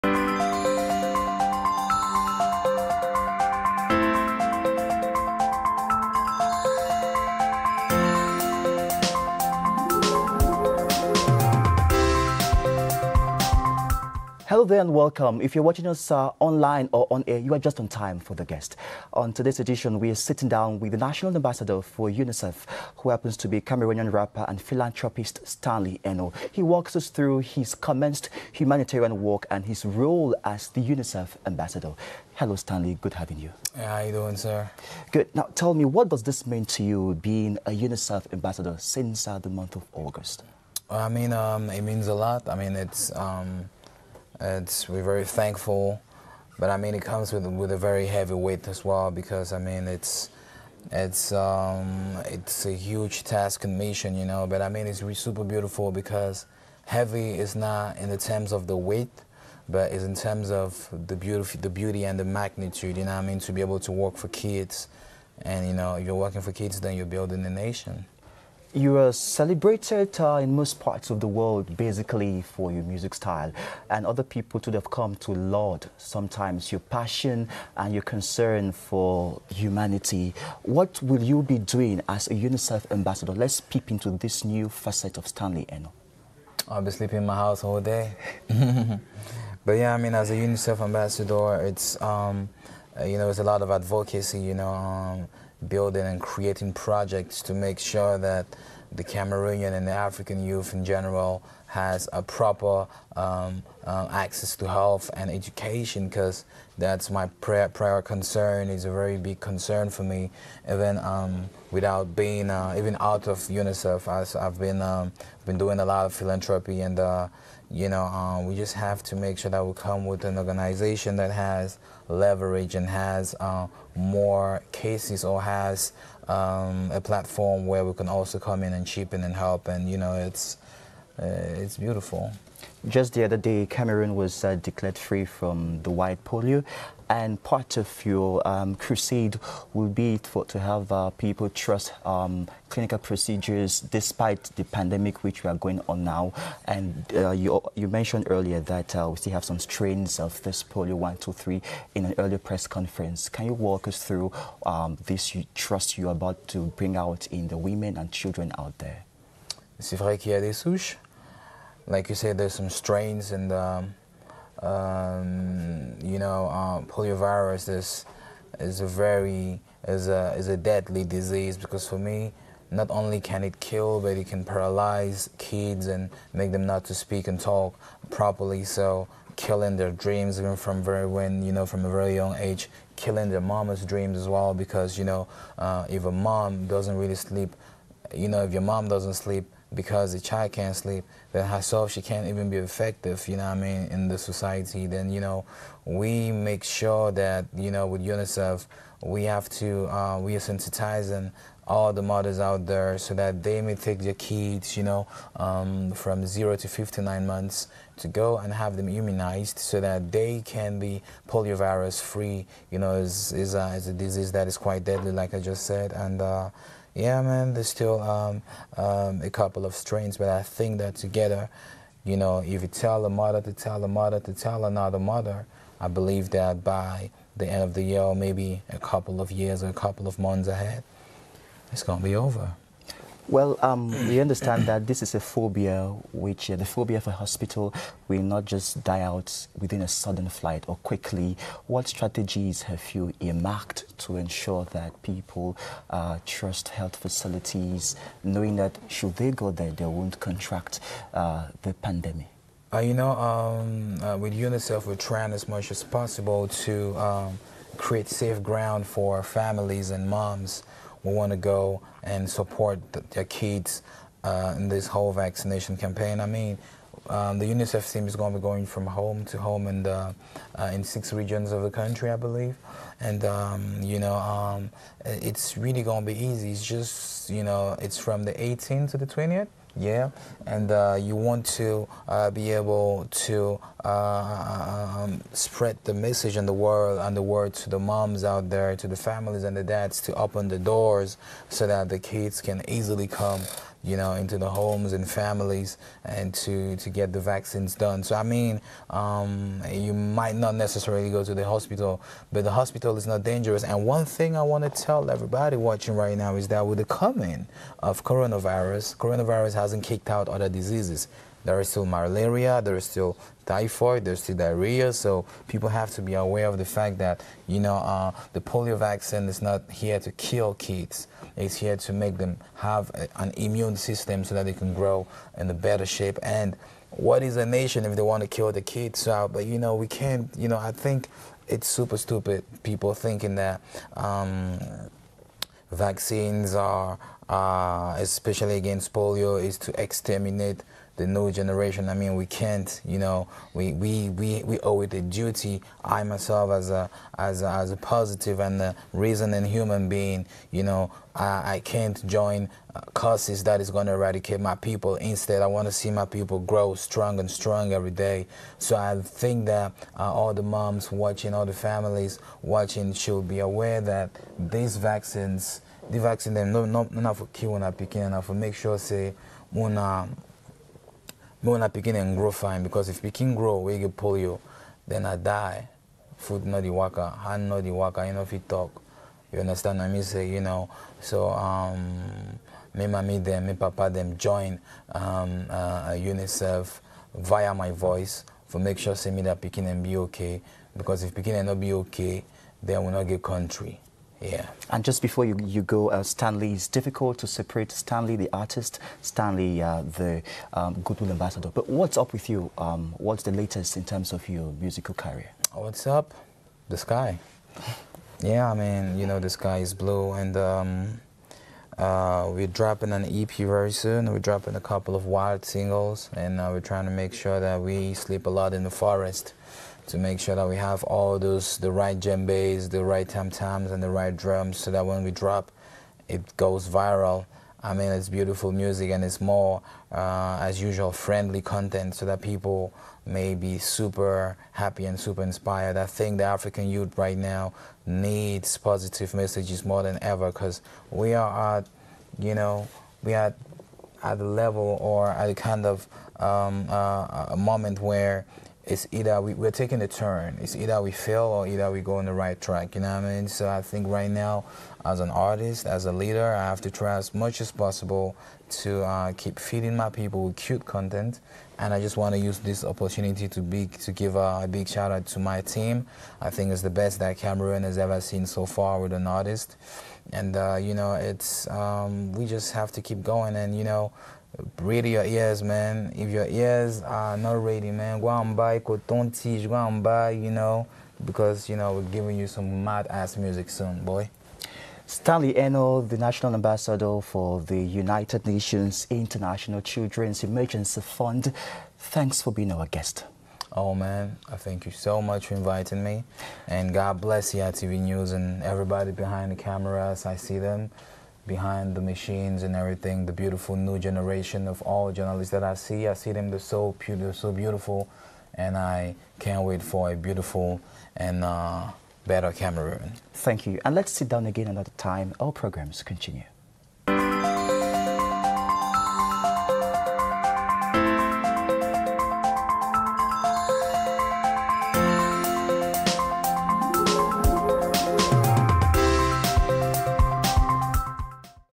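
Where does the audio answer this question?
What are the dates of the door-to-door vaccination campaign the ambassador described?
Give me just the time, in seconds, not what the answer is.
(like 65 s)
278 s.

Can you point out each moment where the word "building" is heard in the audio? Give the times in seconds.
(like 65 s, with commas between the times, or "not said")
67 s, 95 s.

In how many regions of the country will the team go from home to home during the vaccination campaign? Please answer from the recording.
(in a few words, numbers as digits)
six.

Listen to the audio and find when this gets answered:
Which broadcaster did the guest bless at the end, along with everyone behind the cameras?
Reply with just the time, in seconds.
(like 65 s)
497 s.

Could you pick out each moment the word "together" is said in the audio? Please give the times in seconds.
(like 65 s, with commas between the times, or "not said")
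220 s.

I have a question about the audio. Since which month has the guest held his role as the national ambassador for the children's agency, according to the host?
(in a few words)
August.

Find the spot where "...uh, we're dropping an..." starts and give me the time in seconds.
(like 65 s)
411 s.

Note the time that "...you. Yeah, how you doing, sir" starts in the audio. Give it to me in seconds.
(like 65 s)
33 s.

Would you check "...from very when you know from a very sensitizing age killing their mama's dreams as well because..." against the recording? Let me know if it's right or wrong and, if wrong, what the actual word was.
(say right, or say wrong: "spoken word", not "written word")
wrong: "young", not "sensitizing".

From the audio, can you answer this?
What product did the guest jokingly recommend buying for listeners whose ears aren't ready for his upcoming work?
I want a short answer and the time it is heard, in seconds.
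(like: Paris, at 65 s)
Coton Tige, at 478 s.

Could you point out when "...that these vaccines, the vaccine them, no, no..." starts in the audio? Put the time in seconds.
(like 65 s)
363 s.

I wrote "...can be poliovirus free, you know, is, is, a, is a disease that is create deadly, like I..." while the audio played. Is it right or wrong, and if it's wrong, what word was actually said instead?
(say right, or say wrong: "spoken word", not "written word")
wrong: "quite", not "create".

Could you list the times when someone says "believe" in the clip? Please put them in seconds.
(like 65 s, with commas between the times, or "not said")
225 s, 272 s.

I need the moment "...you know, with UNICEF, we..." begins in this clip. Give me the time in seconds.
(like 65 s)
197 s.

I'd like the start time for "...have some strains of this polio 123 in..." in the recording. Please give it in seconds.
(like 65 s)
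149 s.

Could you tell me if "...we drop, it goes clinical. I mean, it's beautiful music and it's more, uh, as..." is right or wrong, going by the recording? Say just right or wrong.
wrong.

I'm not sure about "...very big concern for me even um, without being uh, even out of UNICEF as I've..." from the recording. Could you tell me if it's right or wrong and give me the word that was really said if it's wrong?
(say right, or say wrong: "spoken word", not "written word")
right.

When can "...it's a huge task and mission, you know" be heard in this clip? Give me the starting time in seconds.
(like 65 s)
52 s.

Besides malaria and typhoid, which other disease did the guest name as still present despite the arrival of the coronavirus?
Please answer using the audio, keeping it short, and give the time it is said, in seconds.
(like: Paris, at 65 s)
diarrhea, at 314 s.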